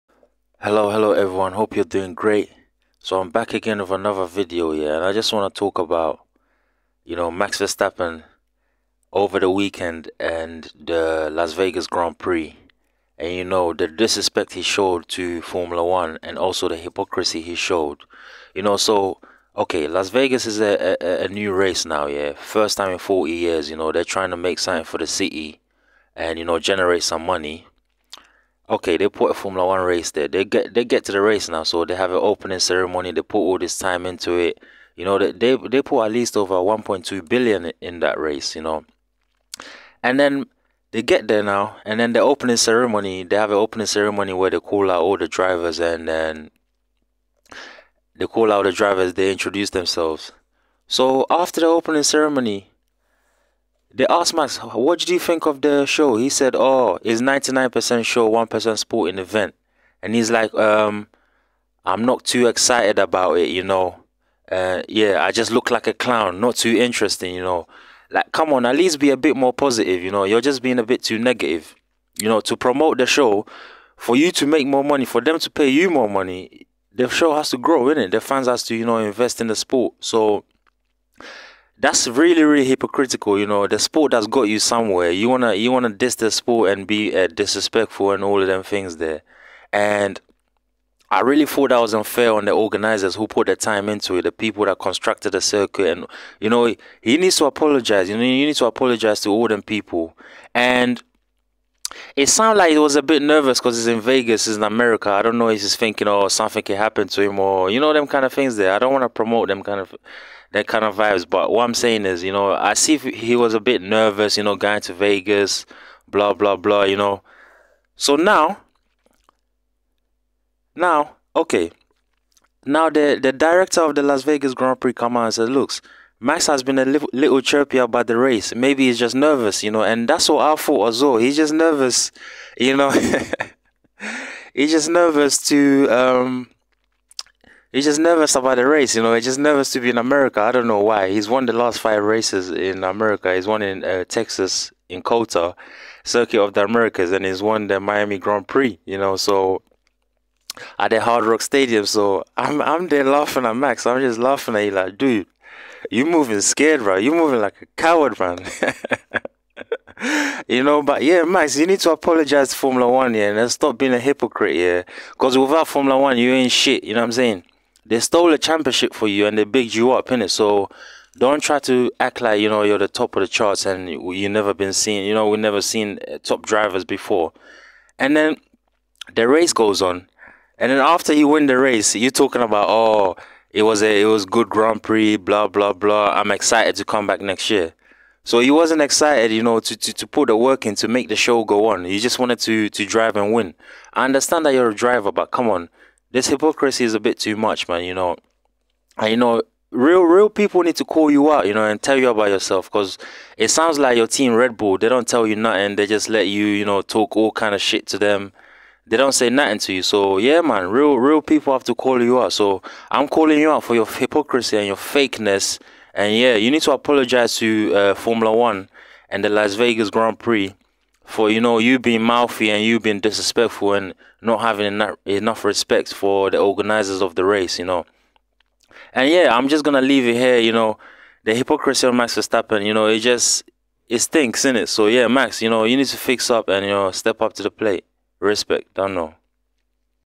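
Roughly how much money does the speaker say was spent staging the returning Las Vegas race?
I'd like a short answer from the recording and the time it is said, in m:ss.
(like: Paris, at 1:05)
over 1.2 billion, at 0:36.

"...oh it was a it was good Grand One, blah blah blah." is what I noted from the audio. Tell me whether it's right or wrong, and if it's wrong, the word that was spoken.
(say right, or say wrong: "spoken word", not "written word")
wrong: "Prix", not "One".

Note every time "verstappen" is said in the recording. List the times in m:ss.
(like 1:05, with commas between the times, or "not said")
0:07, 3:52.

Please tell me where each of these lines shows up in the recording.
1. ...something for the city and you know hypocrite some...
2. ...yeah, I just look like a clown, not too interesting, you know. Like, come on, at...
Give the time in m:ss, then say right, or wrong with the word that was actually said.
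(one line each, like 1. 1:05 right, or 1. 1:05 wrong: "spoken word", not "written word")
1. 0:24 wrong: "generate", not "hypocrite"
2. 1:04 right.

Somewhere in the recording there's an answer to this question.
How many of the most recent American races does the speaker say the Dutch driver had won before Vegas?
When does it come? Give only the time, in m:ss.
2:21.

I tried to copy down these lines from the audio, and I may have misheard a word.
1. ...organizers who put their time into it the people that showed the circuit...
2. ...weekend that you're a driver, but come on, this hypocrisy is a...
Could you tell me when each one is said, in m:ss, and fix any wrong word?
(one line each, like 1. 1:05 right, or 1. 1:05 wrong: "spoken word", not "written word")
1. 1:32 wrong: "constructed", not "showed"
2. 3:14 wrong: "understand", not "weekend".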